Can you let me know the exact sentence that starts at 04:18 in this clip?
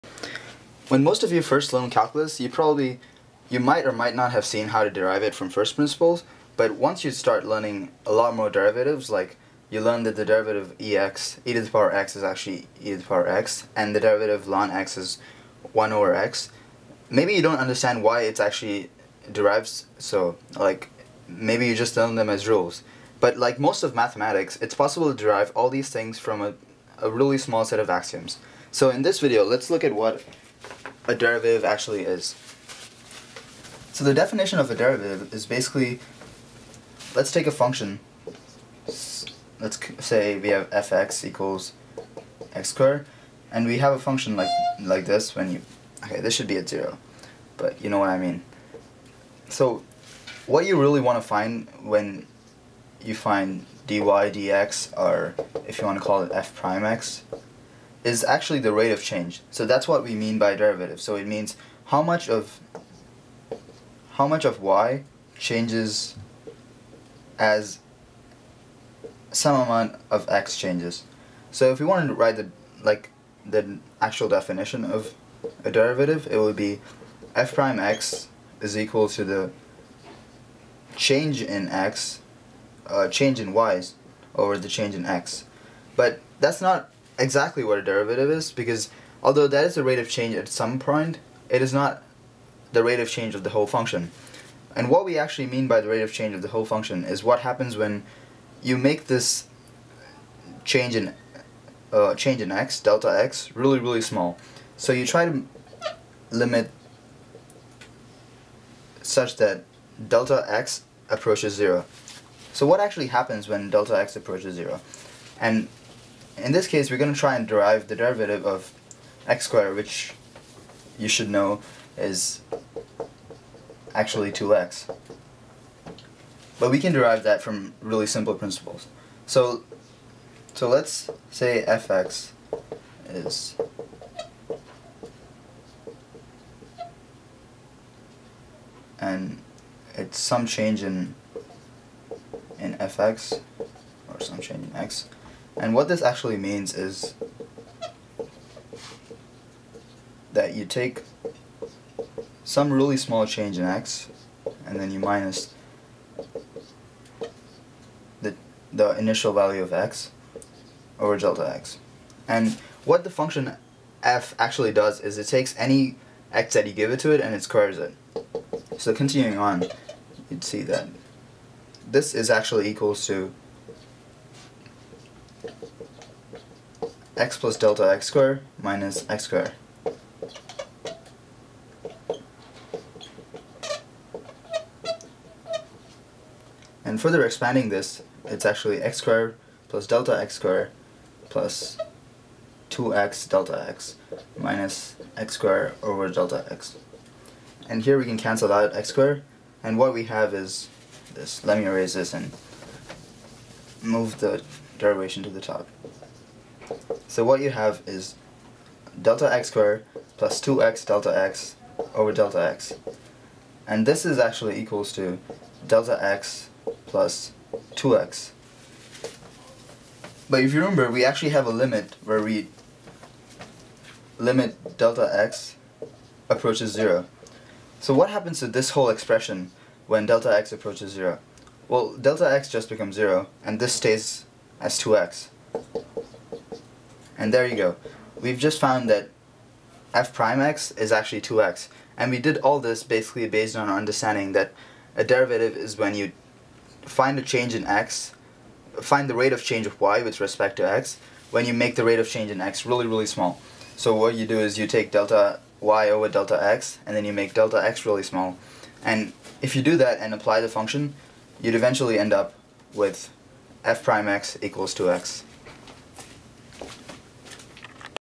And if you do that and apply the function, you'd eventually end up with f prime x equals 2x.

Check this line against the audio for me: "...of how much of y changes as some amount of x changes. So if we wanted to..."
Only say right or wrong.
right.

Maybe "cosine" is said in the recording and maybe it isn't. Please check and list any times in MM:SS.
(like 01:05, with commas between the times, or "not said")
not said.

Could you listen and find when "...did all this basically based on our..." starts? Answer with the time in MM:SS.
04:02.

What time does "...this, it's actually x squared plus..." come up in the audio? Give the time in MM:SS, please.
03:07.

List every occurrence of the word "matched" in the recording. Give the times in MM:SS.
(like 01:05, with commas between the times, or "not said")
not said.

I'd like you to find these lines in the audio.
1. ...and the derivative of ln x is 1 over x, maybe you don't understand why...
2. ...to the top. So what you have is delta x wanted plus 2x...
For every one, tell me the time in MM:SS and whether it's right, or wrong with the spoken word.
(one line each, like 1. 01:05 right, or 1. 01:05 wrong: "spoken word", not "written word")
1. 00:13 right
2. 03:25 wrong: "squared", not "wanted".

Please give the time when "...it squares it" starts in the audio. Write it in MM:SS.
02:47.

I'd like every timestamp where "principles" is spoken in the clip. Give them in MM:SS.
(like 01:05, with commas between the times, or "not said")
00:05, 02:08.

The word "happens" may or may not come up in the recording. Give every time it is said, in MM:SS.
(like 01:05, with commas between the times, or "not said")
01:37, 01:53, 03:48.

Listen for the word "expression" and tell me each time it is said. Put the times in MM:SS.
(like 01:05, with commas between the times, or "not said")
03:48.